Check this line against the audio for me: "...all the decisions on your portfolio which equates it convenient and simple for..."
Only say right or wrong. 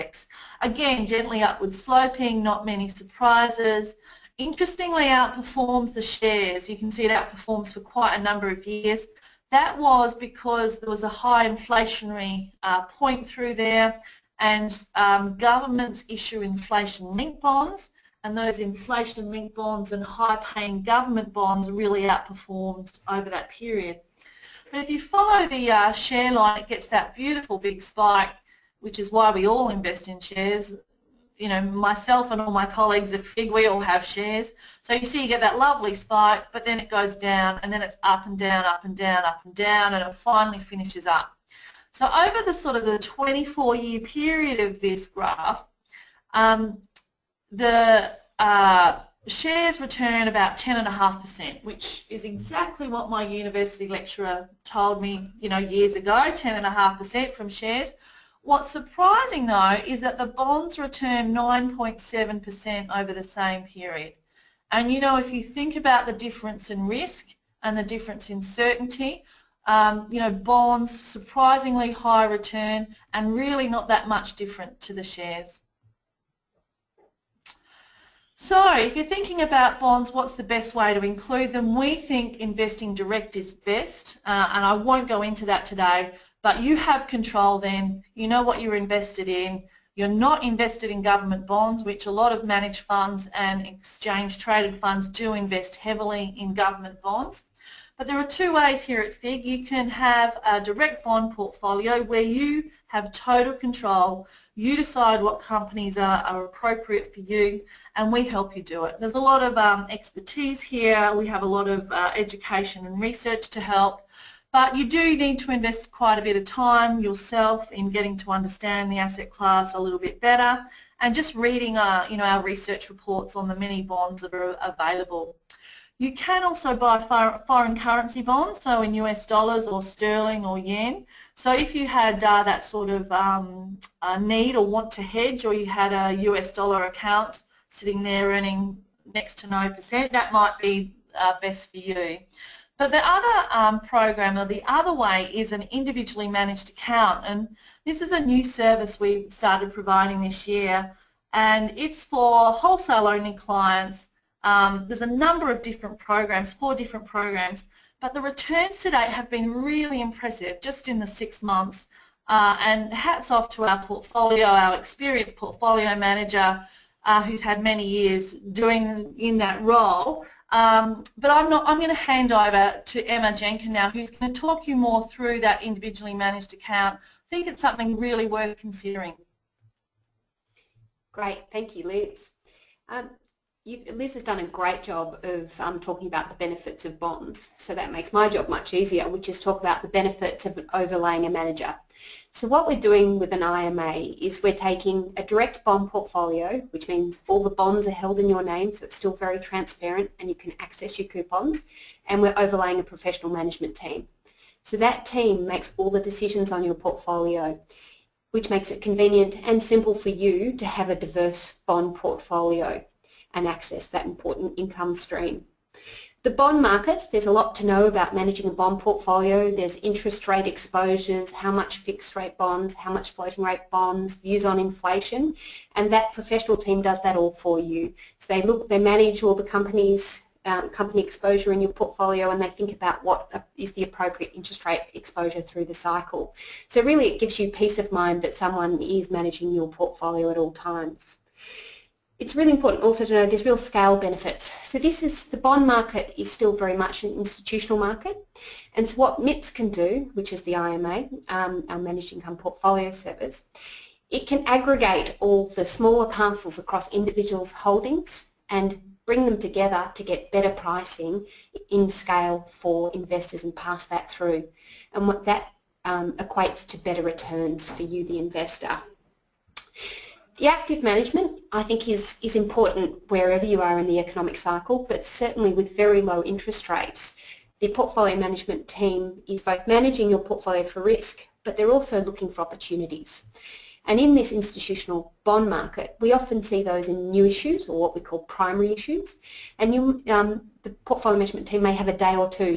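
wrong.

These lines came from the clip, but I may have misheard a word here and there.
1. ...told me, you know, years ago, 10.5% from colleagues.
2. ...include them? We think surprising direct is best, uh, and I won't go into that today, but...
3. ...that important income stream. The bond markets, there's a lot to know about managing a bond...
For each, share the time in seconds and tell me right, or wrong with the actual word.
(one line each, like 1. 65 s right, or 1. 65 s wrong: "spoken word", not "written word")
1. 54 s wrong: "shares", not "colleagues"
2. 81 s wrong: "investing", not "surprising"
3. 213 s right.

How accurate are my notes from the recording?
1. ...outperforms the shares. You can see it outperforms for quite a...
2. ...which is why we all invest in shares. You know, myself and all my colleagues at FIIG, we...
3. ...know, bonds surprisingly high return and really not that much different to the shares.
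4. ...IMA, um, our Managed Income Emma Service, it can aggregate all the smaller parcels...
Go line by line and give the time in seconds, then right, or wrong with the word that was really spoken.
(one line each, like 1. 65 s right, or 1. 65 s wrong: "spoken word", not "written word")
1. 5 s right
2. 28 s right
3. 70 s right
4. 250 s wrong: "Portfolio", not "Emma".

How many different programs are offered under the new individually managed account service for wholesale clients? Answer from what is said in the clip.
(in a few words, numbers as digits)
4.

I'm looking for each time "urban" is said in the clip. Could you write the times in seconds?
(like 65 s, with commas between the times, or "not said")
not said.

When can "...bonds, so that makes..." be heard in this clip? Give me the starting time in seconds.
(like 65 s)
187 s.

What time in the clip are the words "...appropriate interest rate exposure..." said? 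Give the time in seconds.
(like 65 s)
233 s.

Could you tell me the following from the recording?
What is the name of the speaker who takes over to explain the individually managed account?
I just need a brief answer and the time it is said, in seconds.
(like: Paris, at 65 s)
Emma Jenkin, at 173 s.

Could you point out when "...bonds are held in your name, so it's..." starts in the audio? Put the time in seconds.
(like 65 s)
197 s.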